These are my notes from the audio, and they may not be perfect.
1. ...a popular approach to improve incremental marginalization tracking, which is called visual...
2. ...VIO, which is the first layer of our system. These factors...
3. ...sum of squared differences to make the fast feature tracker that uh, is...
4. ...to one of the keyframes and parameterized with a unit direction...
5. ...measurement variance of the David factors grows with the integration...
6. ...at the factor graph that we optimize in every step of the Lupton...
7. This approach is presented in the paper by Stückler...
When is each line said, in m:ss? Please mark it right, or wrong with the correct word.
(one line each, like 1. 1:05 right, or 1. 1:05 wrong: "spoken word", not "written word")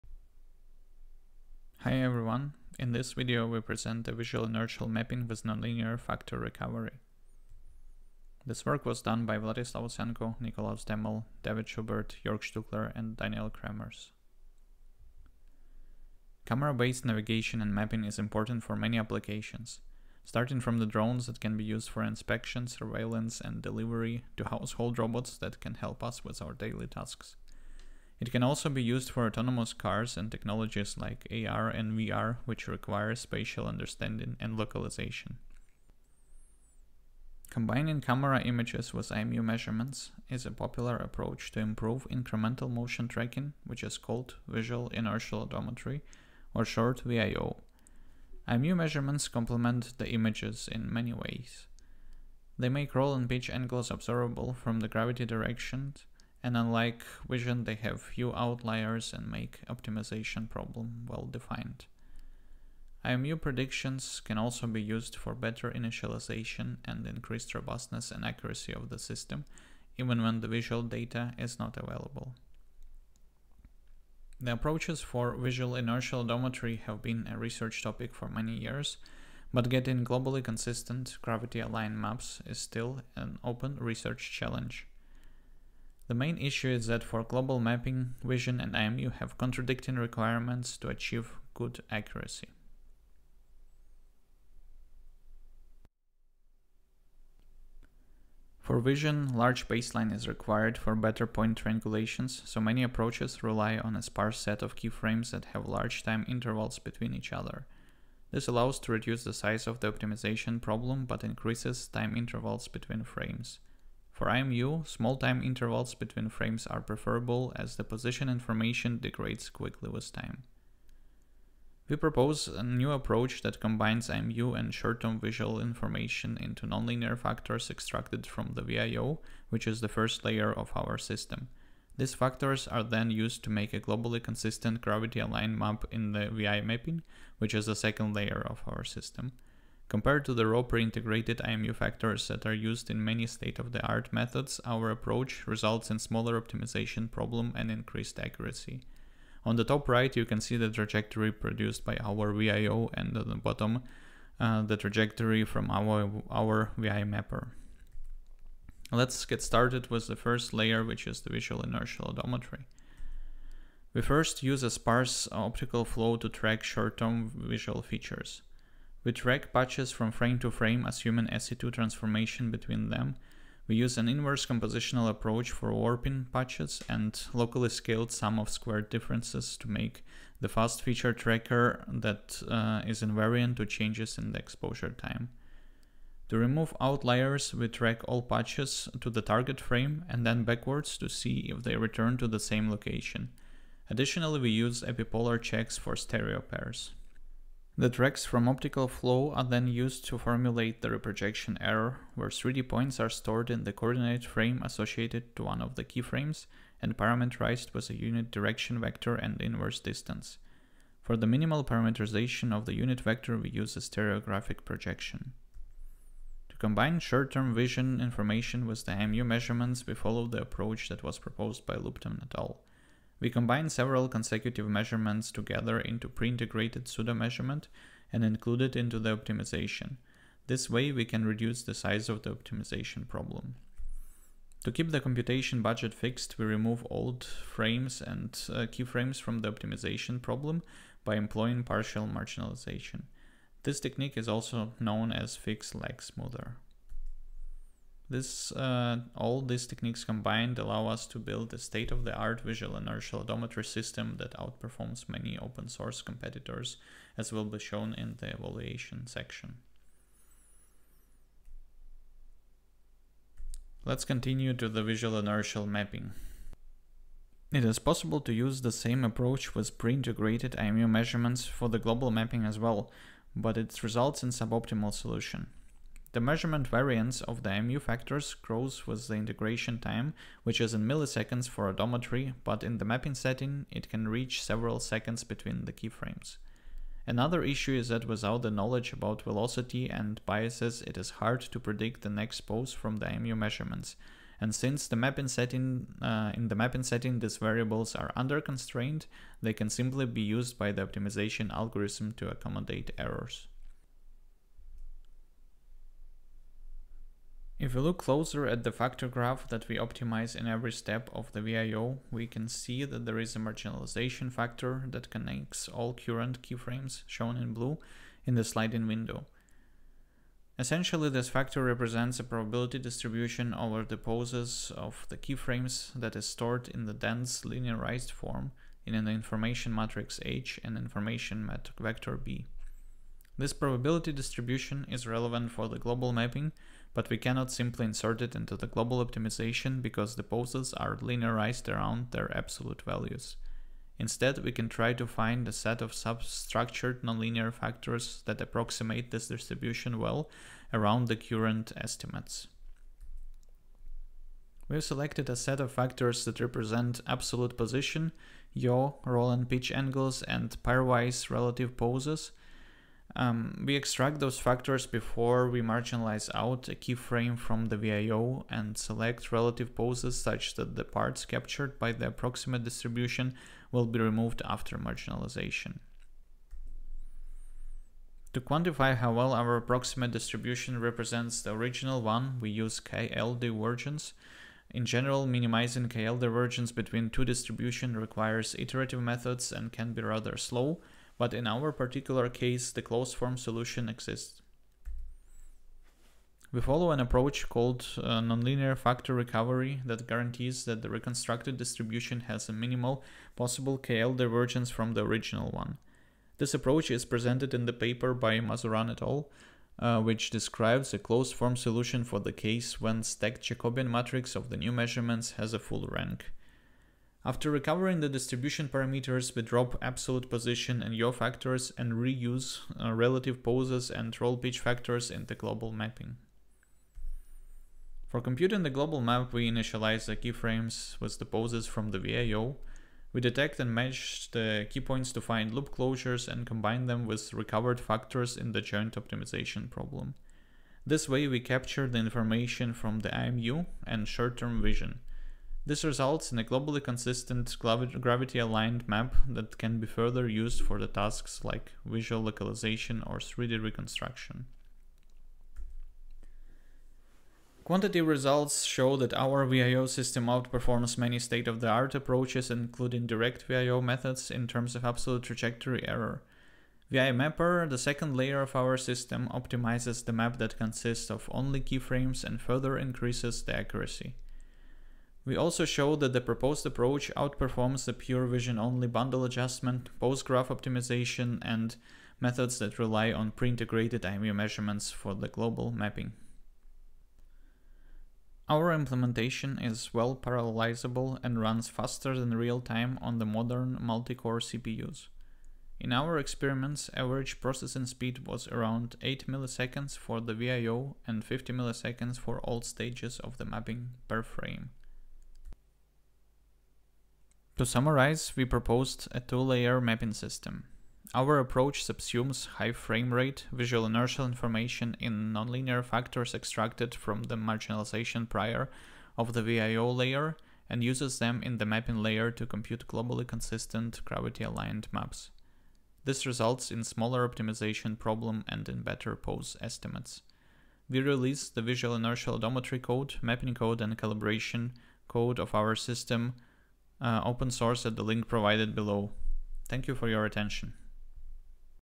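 1. 0:40 wrong: "motion", not "marginalization"
2. 2:08 right
3. 2:58 right
4. 3:25 right
5. 4:36 wrong: "IMU", not "David"
6. 5:08 wrong: "VIO", not "Lupton"
7. 6:46 wrong: "Mazuran", not "Stückler".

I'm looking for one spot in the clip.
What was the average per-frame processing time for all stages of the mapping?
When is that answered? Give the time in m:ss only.
8:21.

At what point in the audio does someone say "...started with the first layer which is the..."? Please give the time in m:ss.
2:39.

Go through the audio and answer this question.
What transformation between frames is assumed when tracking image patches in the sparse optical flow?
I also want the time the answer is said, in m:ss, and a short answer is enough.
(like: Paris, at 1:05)
SE2, at 2:51.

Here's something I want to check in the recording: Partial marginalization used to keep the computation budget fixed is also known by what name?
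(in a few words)
Fixed lag smoother.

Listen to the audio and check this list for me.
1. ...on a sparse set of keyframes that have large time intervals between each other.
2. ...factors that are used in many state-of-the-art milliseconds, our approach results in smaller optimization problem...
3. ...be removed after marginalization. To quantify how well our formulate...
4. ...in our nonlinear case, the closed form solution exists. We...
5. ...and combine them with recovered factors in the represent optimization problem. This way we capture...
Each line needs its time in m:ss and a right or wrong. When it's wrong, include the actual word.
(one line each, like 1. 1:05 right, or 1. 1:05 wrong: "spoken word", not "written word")
1. 1:43 right
2. 2:21 wrong: "methods", not "milliseconds"
3. 6:13 wrong: "approximate", not "formulate"
4. 6:31 wrong: "particular", not "nonlinear"
5. 7:16 wrong: "joint", not "represent".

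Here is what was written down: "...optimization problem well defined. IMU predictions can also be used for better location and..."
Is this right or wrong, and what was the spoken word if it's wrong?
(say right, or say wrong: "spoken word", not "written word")
wrong: "initialization", not "location".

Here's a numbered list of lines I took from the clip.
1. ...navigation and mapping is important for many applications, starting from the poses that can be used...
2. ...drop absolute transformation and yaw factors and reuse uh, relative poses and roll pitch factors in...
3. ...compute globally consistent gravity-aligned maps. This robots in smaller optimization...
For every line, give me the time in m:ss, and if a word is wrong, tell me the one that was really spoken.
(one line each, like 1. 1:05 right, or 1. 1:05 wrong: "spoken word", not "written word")
1. 0:17 wrong: "drones", not "poses"
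2. 6:59 wrong: "position", not "transformation"
3. 8:42 wrong: "results", not "robots".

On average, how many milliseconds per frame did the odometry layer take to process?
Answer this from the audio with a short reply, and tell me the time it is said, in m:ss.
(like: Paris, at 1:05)
8 milliseconds, at 8:19.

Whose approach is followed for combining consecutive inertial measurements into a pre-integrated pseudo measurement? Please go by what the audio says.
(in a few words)
Lupton et al.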